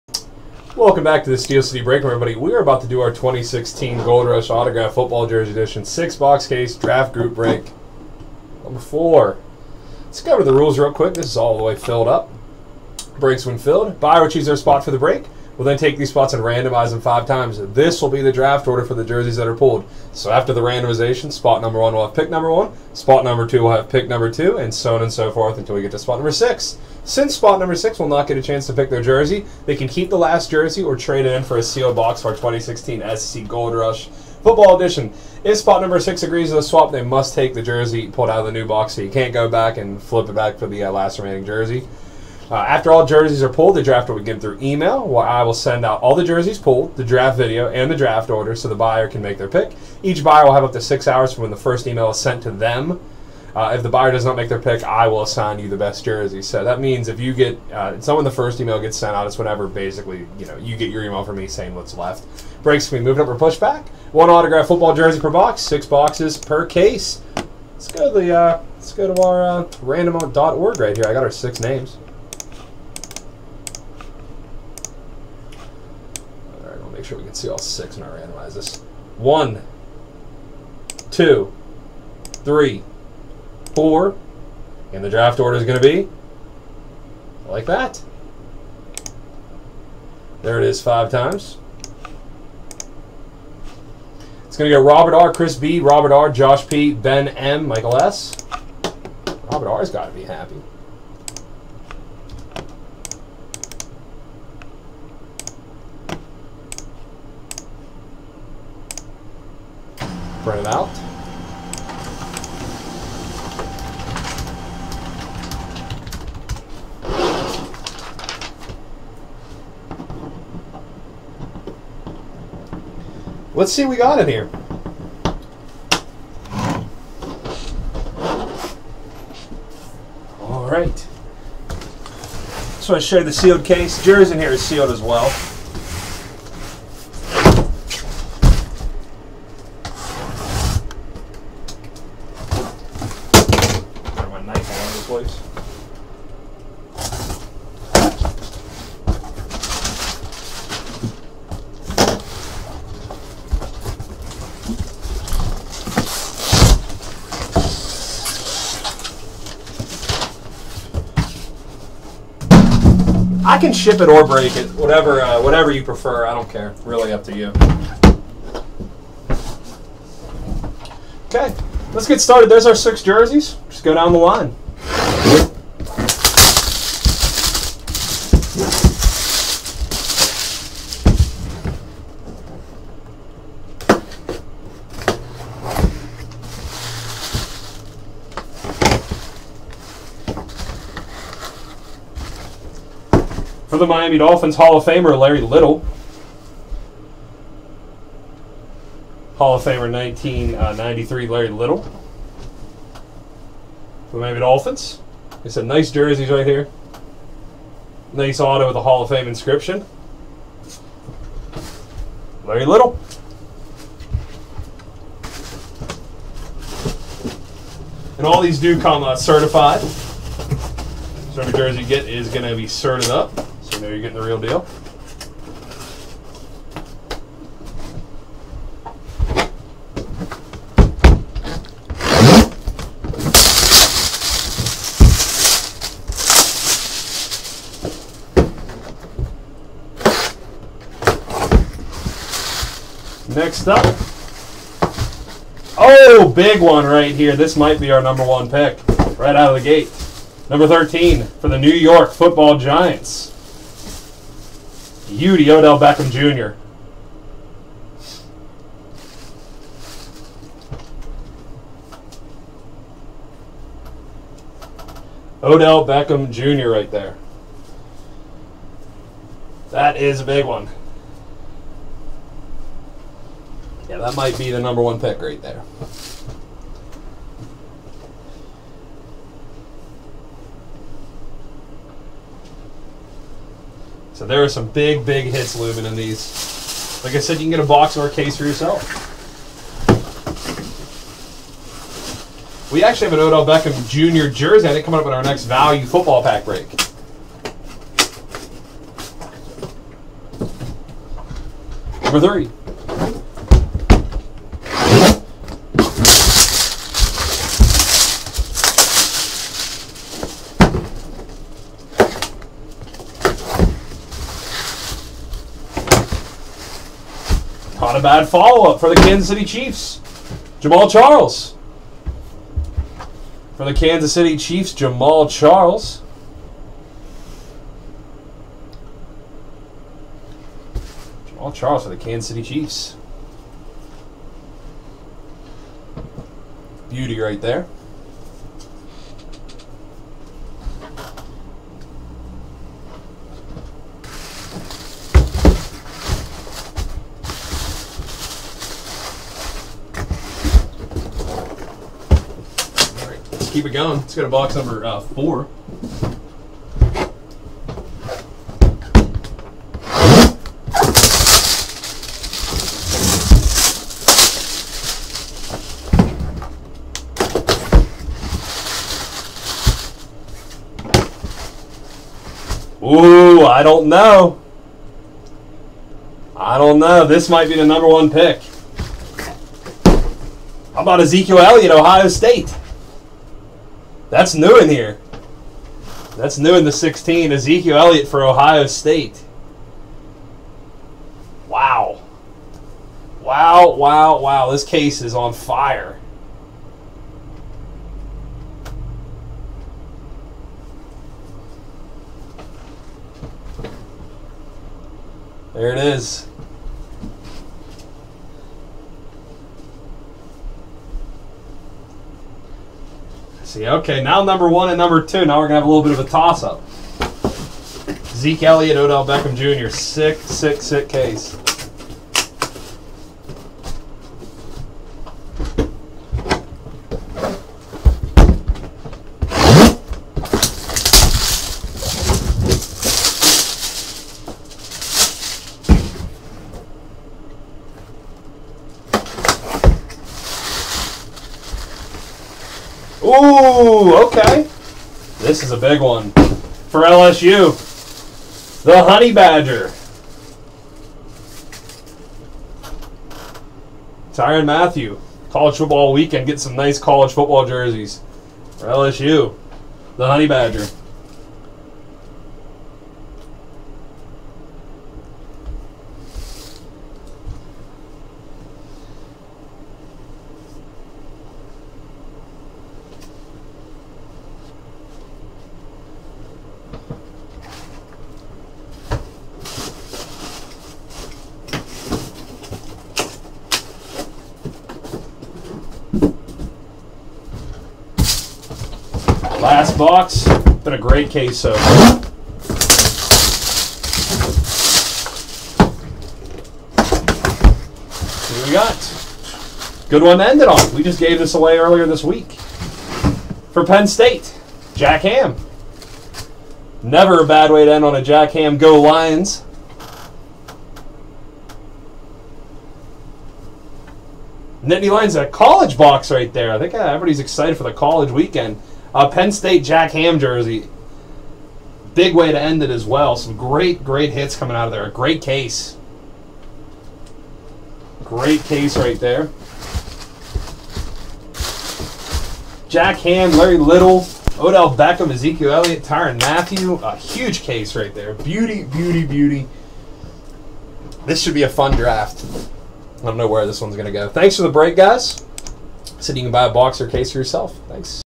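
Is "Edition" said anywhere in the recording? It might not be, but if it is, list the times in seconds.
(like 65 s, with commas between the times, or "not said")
5 s, 34 s.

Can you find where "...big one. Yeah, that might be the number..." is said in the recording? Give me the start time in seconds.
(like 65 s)
270 s.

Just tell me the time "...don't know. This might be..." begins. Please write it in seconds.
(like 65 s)
376 s.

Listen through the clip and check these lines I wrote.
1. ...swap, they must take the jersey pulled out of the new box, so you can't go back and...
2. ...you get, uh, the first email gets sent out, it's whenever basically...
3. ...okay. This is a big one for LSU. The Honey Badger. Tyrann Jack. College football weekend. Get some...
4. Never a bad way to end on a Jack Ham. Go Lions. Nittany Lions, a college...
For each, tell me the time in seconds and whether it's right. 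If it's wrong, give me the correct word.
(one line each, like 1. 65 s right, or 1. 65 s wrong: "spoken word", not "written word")
1. 36 s right
2. 57 s right
3. 444 s wrong: "Mathieu", not "Jack"
4. 506 s right.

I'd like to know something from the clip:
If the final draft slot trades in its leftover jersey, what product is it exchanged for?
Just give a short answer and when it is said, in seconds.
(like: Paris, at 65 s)
a sealed box, at 31 s.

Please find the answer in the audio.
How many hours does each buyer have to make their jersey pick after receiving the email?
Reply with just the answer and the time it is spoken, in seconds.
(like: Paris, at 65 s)
6, at 50 s.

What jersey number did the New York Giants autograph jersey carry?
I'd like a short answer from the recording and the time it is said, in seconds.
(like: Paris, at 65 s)
13, at 250 s.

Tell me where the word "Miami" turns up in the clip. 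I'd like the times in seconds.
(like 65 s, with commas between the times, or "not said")
193 s, 204 s.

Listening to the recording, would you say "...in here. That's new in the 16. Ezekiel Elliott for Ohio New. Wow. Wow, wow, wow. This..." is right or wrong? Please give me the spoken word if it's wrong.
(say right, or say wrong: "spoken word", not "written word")
wrong: "State", not "New".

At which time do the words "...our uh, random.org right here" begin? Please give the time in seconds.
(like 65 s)
69 s.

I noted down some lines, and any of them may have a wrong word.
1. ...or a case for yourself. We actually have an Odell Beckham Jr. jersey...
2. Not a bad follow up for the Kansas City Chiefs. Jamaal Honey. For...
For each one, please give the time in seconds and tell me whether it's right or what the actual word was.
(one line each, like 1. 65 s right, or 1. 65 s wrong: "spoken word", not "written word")
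1. 287 s right
2. 317 s wrong: "Charles", not "Honey".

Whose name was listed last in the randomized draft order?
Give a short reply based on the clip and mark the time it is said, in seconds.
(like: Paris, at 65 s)
Michael S, at 97 s.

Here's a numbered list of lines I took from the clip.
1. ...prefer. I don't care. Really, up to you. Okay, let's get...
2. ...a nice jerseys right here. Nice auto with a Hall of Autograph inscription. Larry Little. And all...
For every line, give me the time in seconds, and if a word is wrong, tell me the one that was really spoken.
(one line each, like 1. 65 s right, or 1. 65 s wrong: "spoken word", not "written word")
1. 165 s right
2. 205 s wrong: "Fame", not "Autograph".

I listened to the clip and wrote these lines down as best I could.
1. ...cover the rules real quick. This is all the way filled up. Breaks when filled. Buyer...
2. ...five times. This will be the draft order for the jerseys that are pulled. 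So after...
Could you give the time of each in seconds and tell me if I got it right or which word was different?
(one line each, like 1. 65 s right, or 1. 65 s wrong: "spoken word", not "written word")
1. 10 s right
2. 17 s right.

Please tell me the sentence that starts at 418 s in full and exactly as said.
Zeke Elliott, Odell Beckham Jr., sick, sick, sick case.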